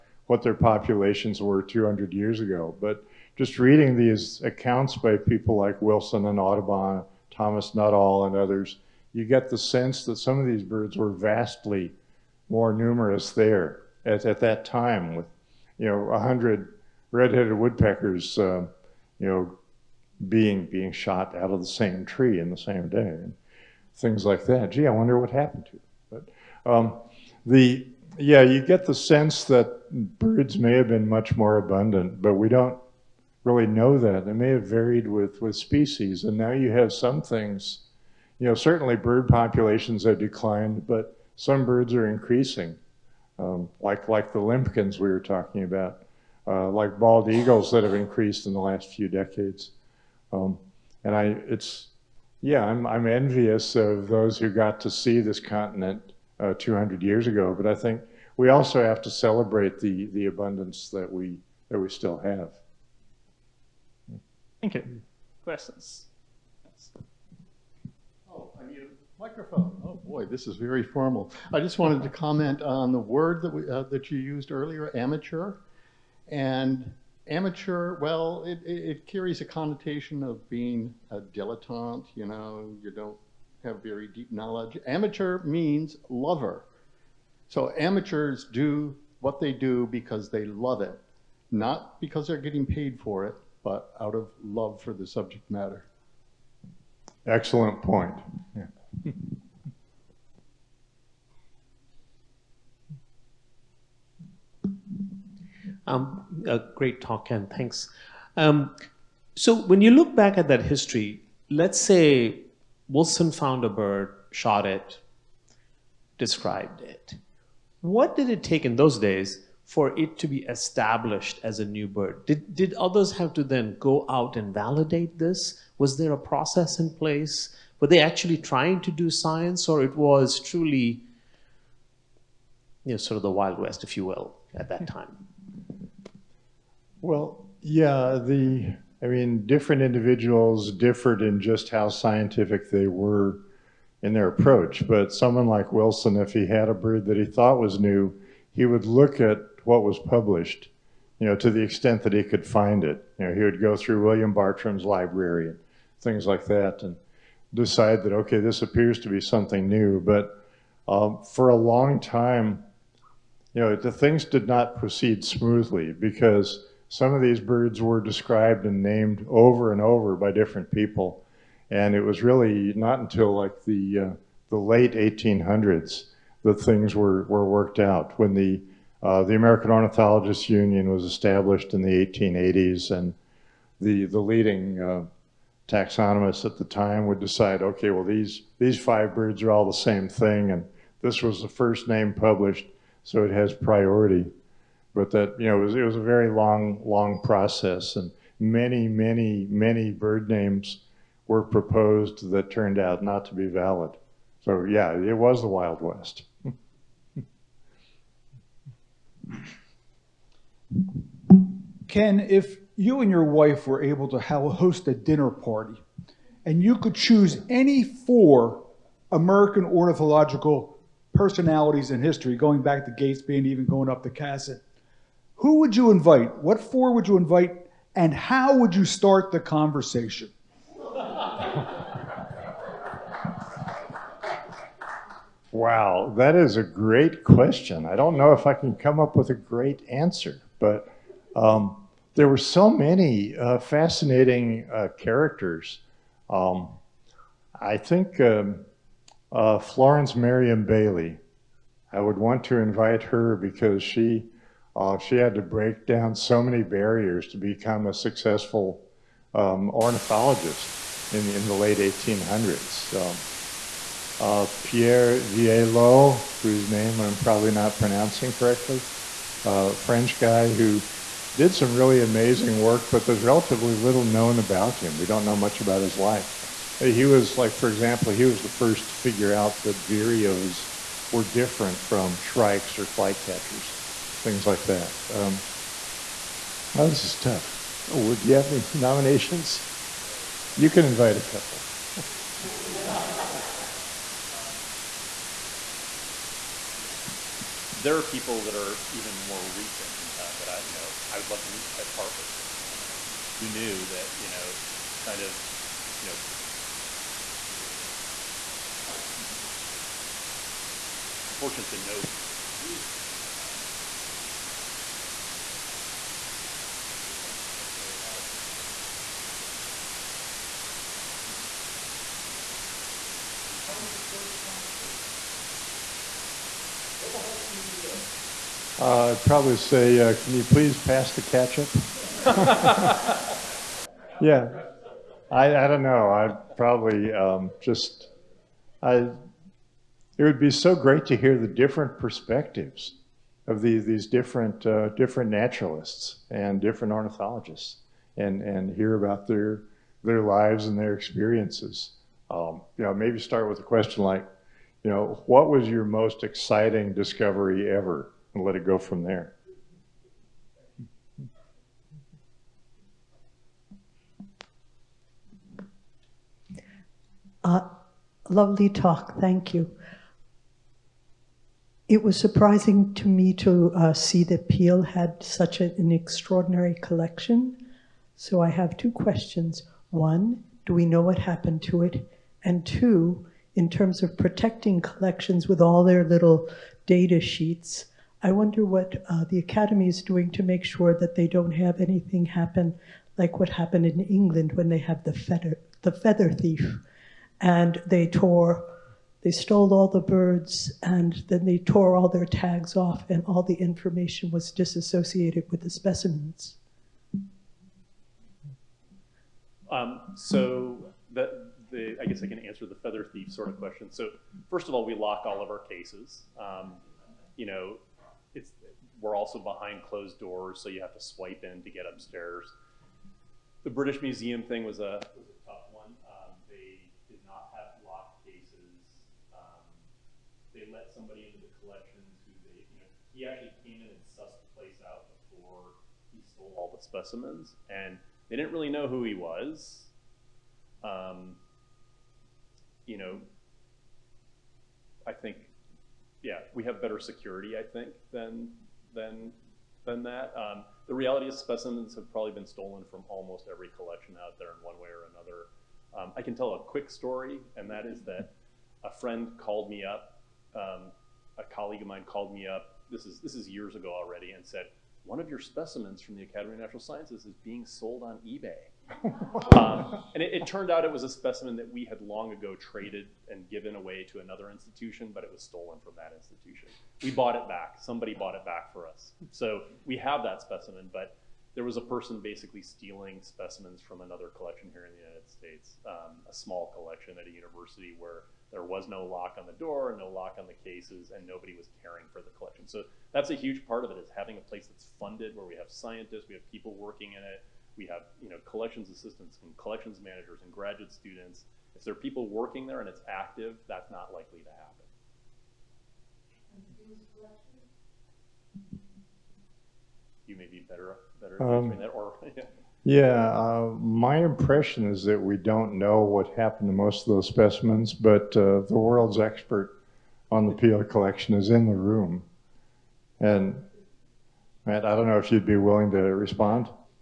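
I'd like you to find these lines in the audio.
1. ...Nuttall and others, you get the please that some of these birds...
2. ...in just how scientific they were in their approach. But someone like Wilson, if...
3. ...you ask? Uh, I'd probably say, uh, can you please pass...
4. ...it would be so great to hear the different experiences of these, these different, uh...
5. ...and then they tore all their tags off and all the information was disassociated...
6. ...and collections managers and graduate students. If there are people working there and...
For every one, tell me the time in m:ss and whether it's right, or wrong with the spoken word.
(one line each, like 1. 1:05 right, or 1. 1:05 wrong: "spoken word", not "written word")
1. 0:07 wrong: "sense", not "please"
2. 2:21 right
3. 5:27 right
4. 5:40 wrong: "perspectives", not "experiences"
5. 6:40 right
6. 8:19 right.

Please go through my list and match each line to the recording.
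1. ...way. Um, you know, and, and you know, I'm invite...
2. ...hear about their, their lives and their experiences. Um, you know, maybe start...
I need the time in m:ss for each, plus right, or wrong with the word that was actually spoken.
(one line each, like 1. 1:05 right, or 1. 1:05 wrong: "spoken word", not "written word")
1. 5:08 wrong: "fortunate", not "invite"
2. 5:48 right.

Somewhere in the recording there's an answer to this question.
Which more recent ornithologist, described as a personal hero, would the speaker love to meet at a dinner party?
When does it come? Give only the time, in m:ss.
5:01.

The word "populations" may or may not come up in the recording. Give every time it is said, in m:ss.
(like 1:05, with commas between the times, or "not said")
0:00, 0:39.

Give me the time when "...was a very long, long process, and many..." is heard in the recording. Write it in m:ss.
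3:15.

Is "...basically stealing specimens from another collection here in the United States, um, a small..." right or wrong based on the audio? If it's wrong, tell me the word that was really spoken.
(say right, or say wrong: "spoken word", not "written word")
right.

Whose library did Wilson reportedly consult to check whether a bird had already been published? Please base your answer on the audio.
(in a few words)
William Bartram.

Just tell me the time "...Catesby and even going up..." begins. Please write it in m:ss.
3:42.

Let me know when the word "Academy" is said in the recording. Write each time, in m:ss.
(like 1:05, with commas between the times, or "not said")
6:29, 7:46.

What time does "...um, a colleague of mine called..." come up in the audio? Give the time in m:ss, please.
7:40.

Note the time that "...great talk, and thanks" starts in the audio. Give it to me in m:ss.
1:46.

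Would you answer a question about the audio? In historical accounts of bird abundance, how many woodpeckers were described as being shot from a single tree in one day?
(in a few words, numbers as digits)
100.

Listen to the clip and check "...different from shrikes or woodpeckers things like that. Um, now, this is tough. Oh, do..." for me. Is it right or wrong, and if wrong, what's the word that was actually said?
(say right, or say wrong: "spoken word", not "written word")
wrong: "flycatchers", not "woodpeckers".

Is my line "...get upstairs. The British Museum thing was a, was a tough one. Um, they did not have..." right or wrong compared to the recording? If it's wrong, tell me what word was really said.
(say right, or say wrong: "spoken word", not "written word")
right.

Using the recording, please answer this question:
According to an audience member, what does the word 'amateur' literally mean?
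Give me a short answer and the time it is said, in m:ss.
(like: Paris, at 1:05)
lover, at 1:24.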